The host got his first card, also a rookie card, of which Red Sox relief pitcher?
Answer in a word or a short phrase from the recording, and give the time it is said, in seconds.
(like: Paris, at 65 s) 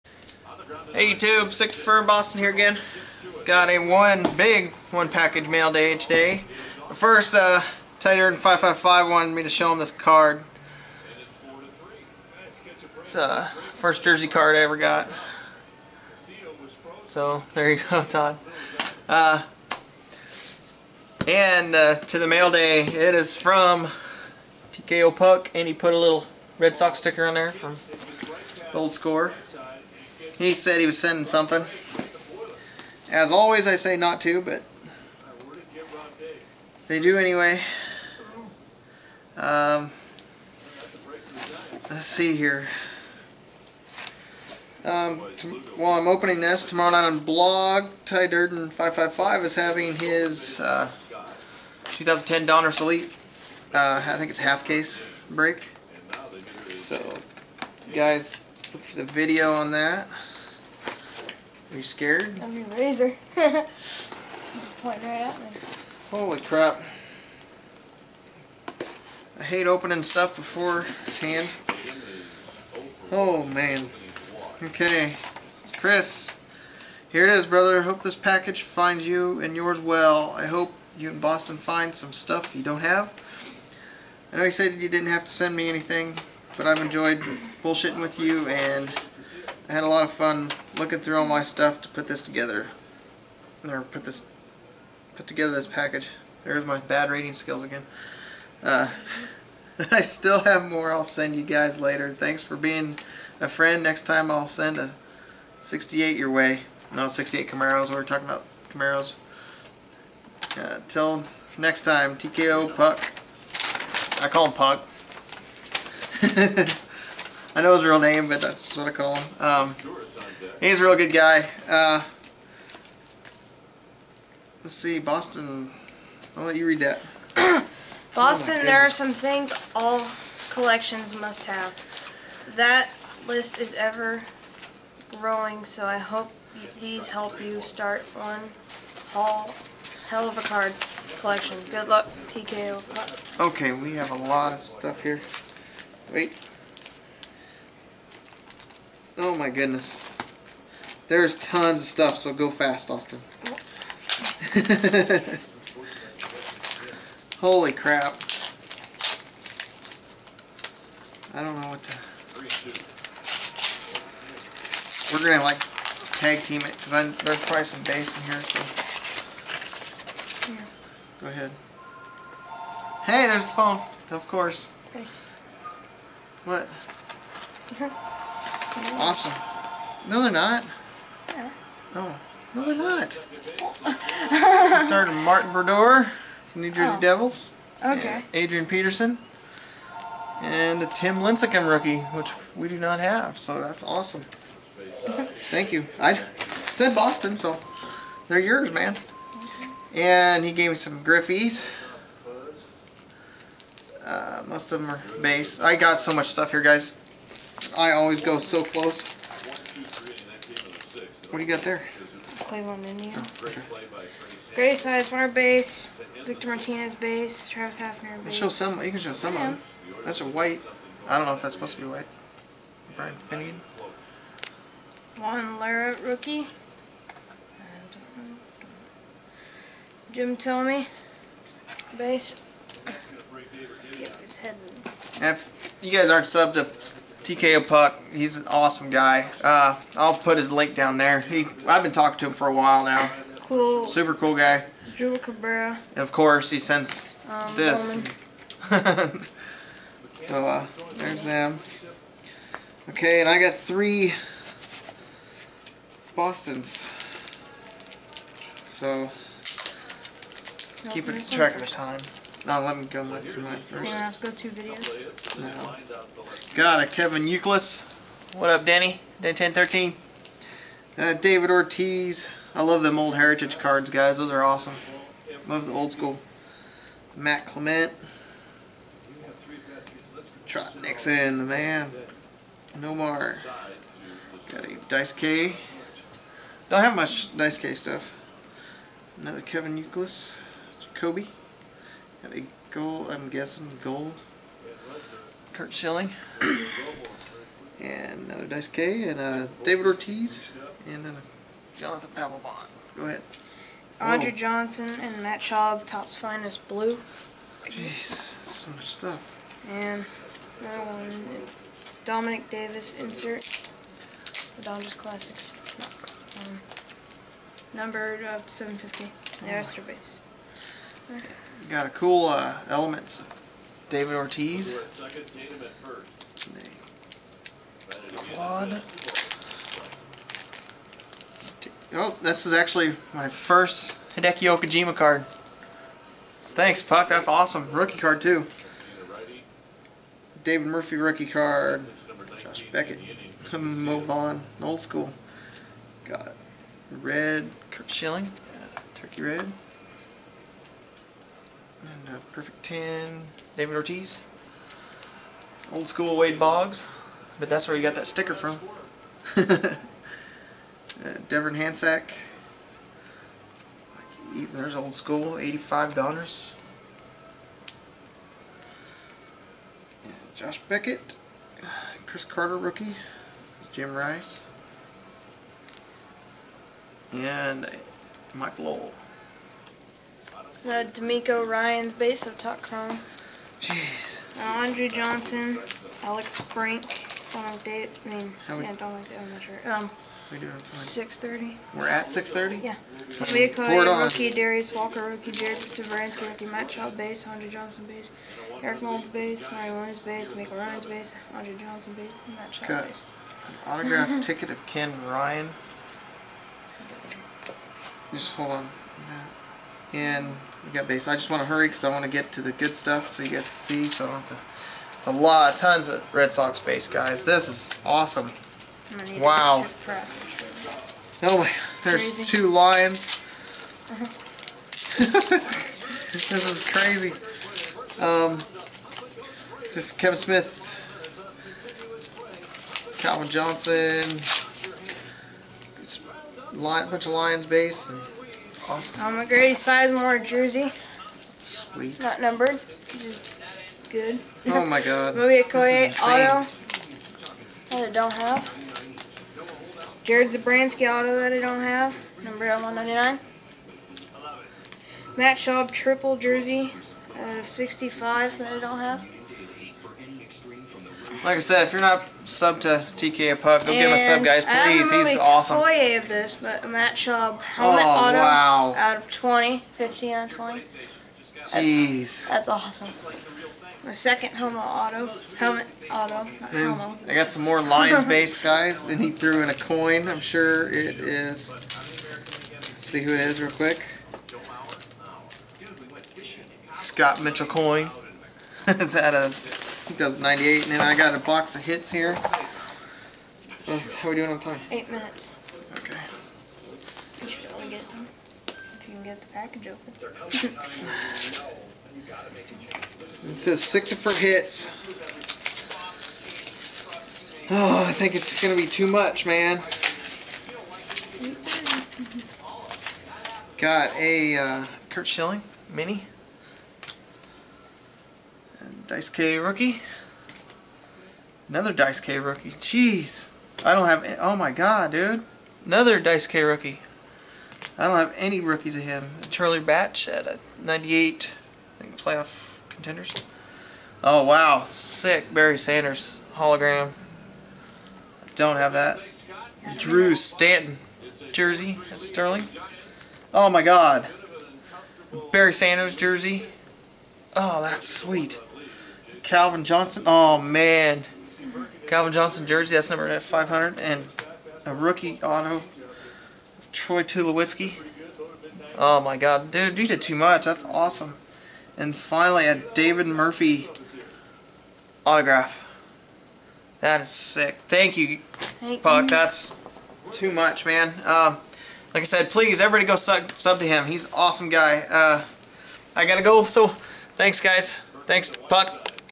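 Hideki Okajima, at 334 s.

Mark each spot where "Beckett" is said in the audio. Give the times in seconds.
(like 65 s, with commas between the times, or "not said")
342 s, 370 s.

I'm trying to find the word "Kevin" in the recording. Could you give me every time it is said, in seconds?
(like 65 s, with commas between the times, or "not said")
266 s, 289 s, 429 s.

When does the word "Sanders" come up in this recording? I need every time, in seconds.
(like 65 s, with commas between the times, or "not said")
535 s, 545 s.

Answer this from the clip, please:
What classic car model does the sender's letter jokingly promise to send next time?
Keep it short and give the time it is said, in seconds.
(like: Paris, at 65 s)
68 Camaros, at 107 s.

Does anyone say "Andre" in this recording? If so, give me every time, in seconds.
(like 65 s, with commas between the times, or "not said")
303 s, 384 s, 397 s, 401 s.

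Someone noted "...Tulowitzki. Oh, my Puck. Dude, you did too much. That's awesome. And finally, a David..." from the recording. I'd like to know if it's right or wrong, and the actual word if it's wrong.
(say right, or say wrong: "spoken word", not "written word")
wrong: "God", not "Puck".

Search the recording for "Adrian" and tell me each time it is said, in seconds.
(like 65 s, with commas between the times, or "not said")
188 s.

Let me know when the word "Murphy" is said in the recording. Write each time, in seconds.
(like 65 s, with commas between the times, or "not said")
340 s, 563 s.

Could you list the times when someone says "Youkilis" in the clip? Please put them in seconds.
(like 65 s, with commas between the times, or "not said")
267 s, 289 s.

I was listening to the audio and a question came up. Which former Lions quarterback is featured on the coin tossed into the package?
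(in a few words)
Scott Mitchell.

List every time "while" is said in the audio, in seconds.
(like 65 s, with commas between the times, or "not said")
45 s, 242 s.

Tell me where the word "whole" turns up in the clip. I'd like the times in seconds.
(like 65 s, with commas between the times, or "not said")
139 s.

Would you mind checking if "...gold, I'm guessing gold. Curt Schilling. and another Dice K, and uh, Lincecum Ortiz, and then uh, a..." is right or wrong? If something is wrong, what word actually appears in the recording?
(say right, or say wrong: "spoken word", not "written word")
wrong: "David", not "Lincecum".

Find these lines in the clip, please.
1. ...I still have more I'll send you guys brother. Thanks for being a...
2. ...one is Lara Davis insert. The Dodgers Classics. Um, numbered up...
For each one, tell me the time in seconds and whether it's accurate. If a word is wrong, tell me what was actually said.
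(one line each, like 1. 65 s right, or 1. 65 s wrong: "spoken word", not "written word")
1. 99 s wrong: "later", not "brother"
2. 310 s wrong: "Domanick", not "Lara".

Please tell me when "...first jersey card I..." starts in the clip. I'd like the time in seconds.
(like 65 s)
13 s.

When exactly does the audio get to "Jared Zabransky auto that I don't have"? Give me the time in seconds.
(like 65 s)
450 s.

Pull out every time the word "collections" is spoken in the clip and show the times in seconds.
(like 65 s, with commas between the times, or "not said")
130 s, 141 s.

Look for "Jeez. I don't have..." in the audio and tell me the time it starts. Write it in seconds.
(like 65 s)
522 s.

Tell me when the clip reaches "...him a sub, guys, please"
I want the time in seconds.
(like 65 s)
463 s.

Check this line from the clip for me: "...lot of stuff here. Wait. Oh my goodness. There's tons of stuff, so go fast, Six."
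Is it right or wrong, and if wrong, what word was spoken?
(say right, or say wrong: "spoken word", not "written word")
wrong: "Austin", not "Six".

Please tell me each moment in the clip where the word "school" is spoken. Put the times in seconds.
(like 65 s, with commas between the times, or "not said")
275 s, 344 s, 355 s, 364 s.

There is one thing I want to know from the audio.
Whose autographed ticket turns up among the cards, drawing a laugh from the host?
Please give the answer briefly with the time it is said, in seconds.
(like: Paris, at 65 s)
Ken Ryan, at 404 s.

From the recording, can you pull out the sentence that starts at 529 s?
Charlie Batch at a 98 I think playoff contenders.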